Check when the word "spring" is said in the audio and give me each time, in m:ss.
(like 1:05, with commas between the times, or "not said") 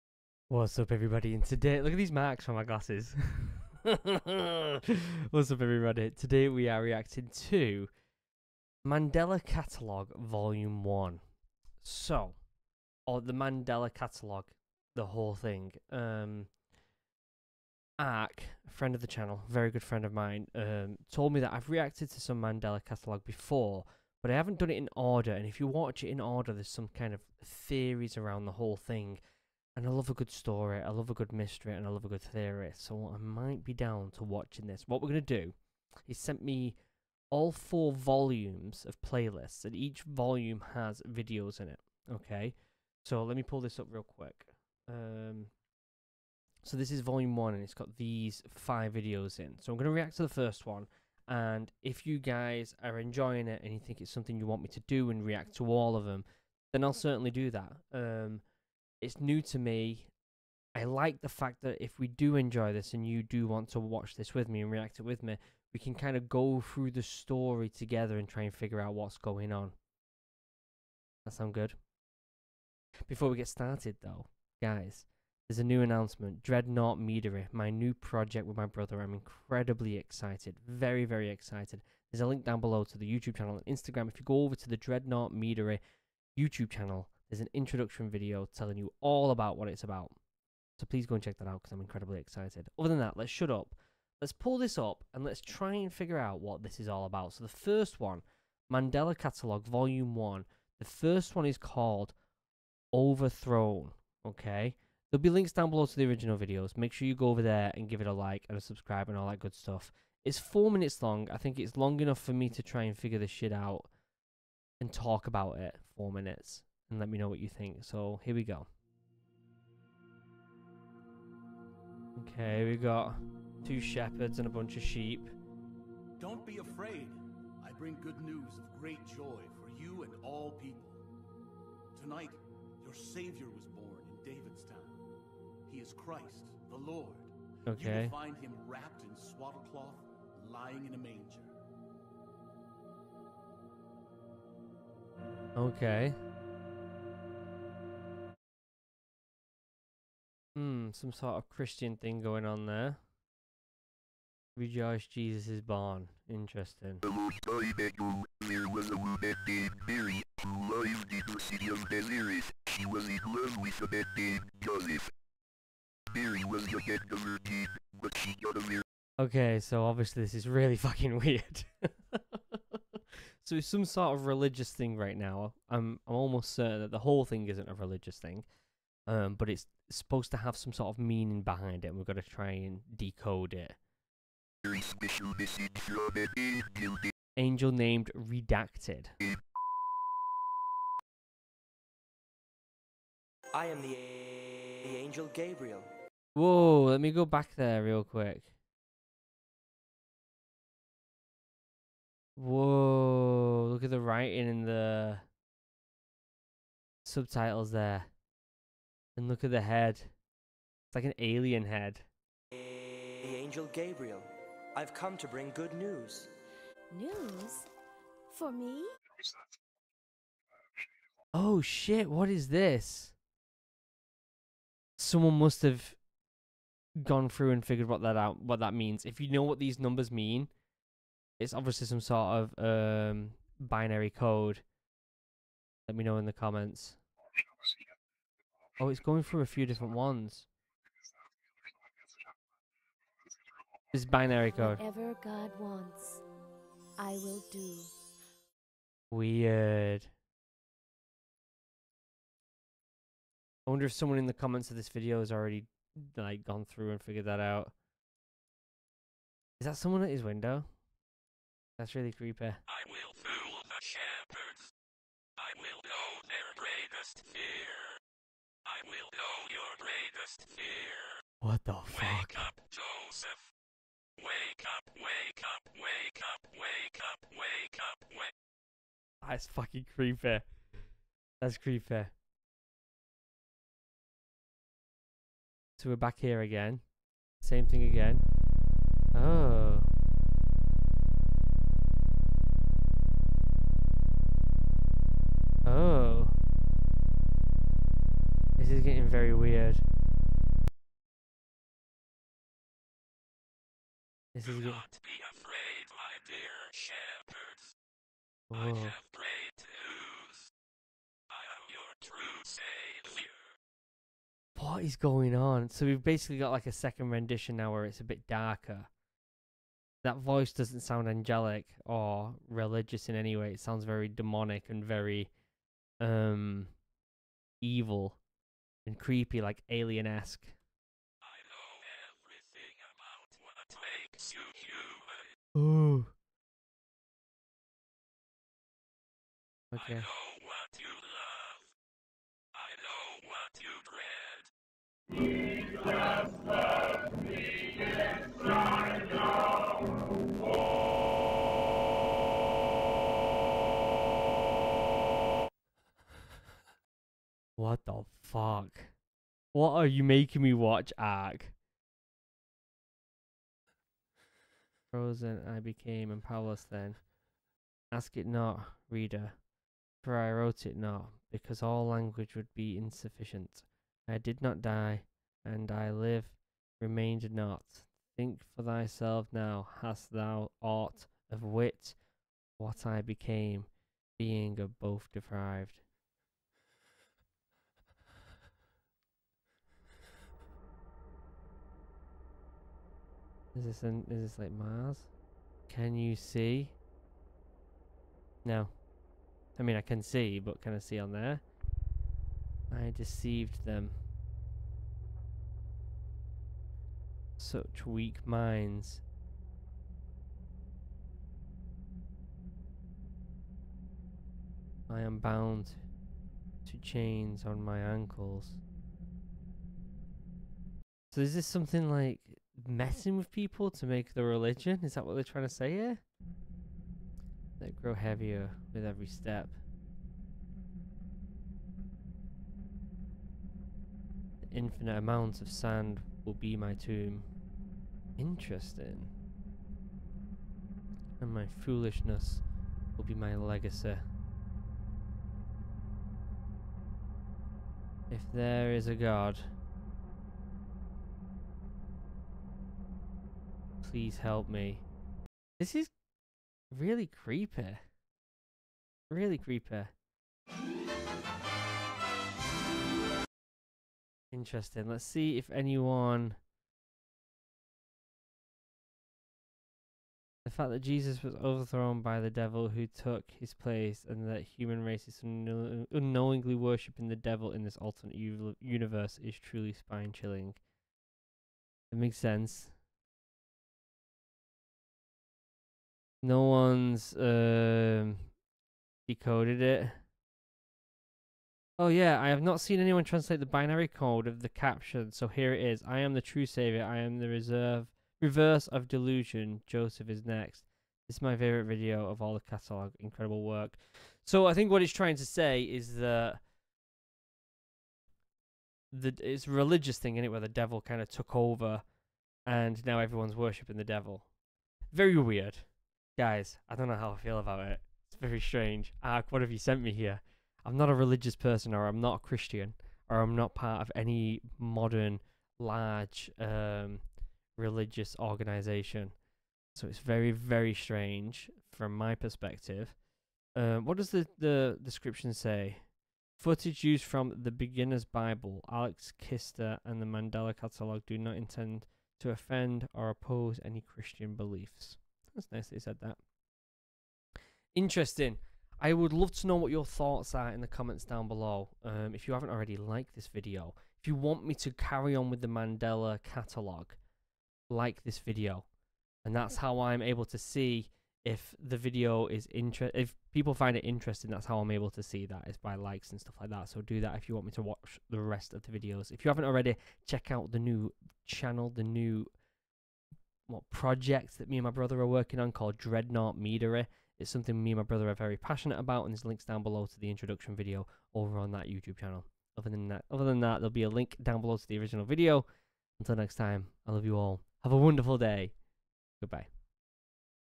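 not said.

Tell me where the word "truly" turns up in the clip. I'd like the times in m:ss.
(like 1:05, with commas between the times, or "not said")
7:59.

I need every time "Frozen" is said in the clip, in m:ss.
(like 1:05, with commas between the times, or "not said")
6:04.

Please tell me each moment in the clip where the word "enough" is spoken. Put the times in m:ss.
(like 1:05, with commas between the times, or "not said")
1:52.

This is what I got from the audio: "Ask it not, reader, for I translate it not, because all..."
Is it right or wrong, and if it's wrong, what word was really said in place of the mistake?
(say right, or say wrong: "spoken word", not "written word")
wrong: "wrote", not "translate".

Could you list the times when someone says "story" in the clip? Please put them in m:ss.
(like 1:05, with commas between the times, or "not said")
0:30, 1:07.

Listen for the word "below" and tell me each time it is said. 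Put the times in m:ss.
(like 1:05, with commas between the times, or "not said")
1:22, 1:45, 9:11, 9:39, 9:44.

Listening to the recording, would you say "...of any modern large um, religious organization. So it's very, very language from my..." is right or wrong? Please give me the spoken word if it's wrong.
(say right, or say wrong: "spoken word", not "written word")
wrong: "strange", not "language".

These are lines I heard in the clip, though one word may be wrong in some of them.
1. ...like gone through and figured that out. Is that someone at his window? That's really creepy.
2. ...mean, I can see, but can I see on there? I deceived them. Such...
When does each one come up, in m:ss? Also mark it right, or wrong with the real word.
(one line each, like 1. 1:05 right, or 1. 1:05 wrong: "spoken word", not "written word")
1. 4:16 right
2. 6:39 right.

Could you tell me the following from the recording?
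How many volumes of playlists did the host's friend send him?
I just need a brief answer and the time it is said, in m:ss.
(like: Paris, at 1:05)
4, at 0:37.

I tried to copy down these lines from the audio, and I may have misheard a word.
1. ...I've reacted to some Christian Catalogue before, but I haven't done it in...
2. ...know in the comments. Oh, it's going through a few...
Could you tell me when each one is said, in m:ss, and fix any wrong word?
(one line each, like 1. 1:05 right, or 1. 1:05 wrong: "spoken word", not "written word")
1. 0:21 wrong: "Mandela", not "Christian"
2. 3:56 right.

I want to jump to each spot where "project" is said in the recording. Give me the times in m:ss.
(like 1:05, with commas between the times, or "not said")
1:17, 9:33.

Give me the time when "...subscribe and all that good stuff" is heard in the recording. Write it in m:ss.
1:48.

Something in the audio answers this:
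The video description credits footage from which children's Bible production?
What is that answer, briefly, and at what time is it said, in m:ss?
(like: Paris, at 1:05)
The Beginner's Bible, at 8:57.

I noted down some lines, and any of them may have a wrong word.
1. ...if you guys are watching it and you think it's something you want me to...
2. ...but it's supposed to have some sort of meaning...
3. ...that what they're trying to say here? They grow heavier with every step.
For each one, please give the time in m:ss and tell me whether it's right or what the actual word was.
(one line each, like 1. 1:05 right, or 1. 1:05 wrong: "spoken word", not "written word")
1. 0:51 wrong: "enjoying", not "watching"
2. 2:59 right
3. 7:04 right.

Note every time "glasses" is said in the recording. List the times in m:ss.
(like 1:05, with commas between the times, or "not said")
0:02.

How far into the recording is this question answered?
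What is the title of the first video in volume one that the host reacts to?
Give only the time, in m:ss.
1:42.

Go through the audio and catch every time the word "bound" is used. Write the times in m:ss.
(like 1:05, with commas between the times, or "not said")
6:55.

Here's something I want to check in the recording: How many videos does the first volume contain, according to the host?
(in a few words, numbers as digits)
5.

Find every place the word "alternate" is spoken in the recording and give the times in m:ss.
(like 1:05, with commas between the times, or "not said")
7:57.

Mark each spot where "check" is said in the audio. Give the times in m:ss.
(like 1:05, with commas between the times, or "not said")
1:31, 9:30.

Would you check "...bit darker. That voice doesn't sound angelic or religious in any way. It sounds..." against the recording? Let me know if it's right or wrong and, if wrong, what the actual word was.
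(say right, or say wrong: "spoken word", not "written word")
right.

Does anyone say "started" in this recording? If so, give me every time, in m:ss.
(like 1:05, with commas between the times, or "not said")
1:13.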